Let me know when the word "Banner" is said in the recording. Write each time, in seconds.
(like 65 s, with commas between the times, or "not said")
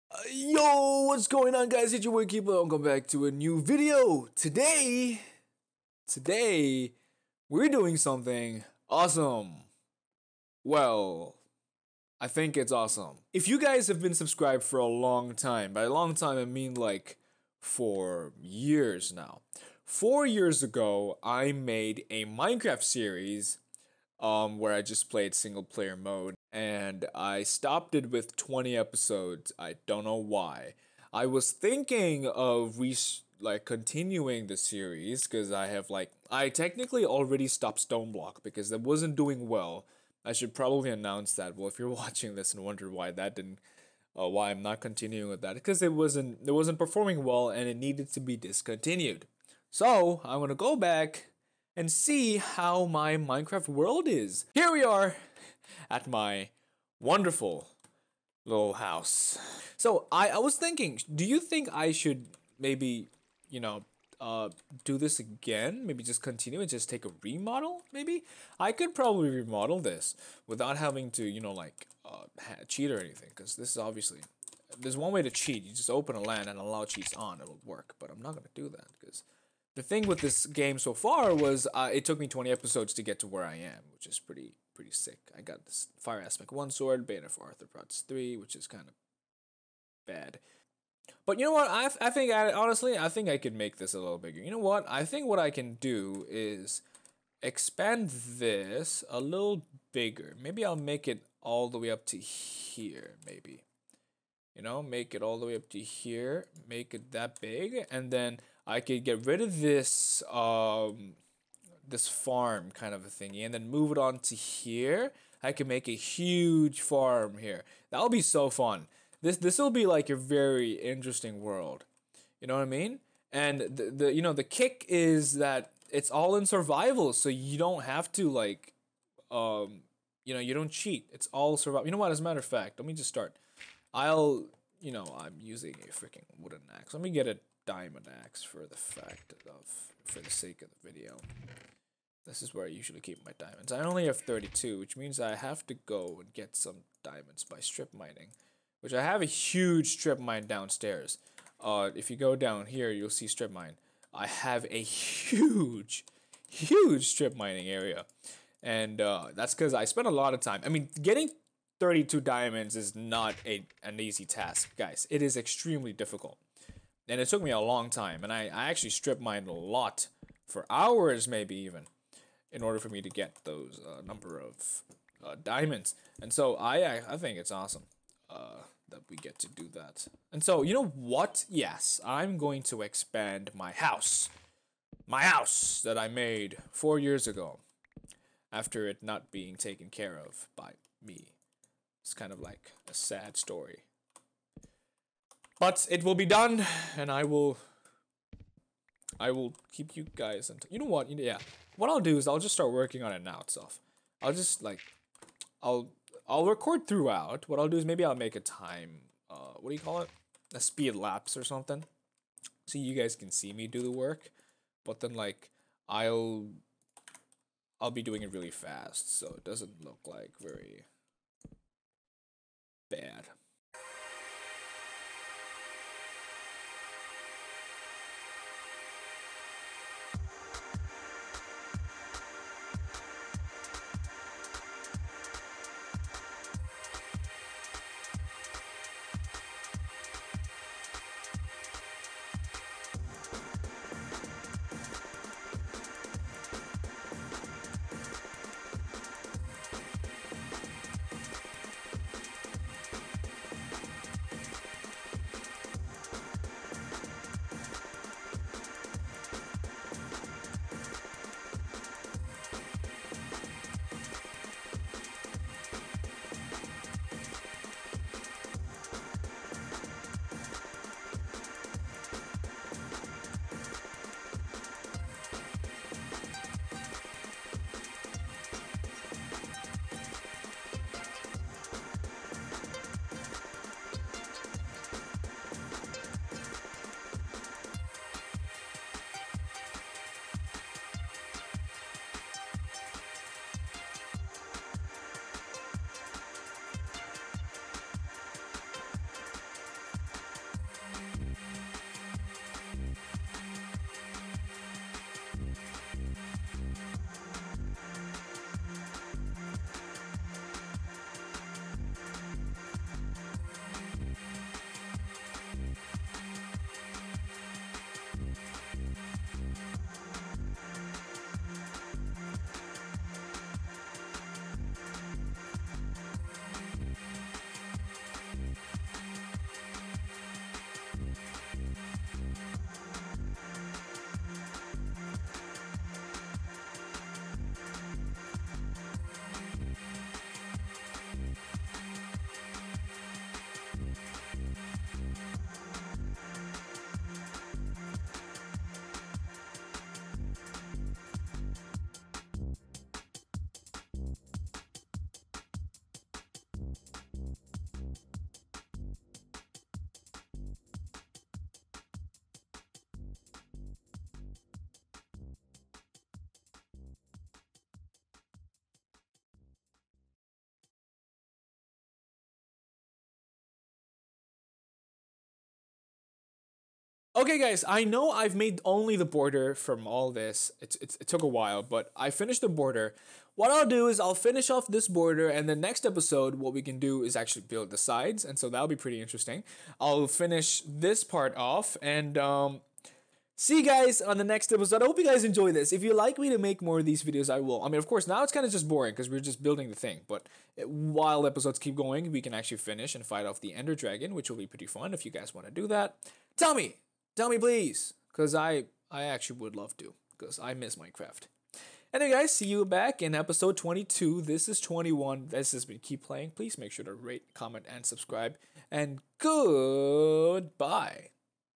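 87 s.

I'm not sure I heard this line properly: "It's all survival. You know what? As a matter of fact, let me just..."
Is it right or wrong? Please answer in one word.
right.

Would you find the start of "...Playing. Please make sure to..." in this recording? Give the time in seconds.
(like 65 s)
416 s.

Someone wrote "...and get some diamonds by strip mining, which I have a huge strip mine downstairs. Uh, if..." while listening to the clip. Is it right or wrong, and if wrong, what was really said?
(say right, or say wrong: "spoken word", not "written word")
right.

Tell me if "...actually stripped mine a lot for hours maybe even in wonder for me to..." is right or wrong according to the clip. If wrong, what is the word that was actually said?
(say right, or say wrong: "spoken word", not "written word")
wrong: "order", not "wonder".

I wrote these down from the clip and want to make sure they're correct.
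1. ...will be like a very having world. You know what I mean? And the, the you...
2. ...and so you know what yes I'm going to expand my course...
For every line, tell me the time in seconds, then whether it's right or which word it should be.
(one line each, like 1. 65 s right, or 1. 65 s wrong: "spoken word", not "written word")
1. 119 s wrong: "interesting", not "having"
2. 180 s wrong: "house", not "course".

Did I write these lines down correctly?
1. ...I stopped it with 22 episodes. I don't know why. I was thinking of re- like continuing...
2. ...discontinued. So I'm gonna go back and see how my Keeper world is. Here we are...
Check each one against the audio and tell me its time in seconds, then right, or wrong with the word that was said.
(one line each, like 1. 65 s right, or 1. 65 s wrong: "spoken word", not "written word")
1. 27 s wrong: "20", not "22"
2. 48 s wrong: "Minecraft", not "Keeper".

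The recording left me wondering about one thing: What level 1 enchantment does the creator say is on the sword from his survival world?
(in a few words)
Fire Aspect.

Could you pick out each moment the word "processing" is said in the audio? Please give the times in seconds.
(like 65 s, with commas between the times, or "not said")
not said.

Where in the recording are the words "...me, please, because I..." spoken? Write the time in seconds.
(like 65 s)
407 s.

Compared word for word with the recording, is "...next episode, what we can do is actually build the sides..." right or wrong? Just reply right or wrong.
right.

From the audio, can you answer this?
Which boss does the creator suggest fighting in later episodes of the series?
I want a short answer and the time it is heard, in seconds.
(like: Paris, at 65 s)
Ender Dragon, at 403 s.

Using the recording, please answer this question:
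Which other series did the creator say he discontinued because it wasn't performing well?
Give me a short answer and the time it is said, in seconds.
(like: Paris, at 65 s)
Stoneblock, at 37 s.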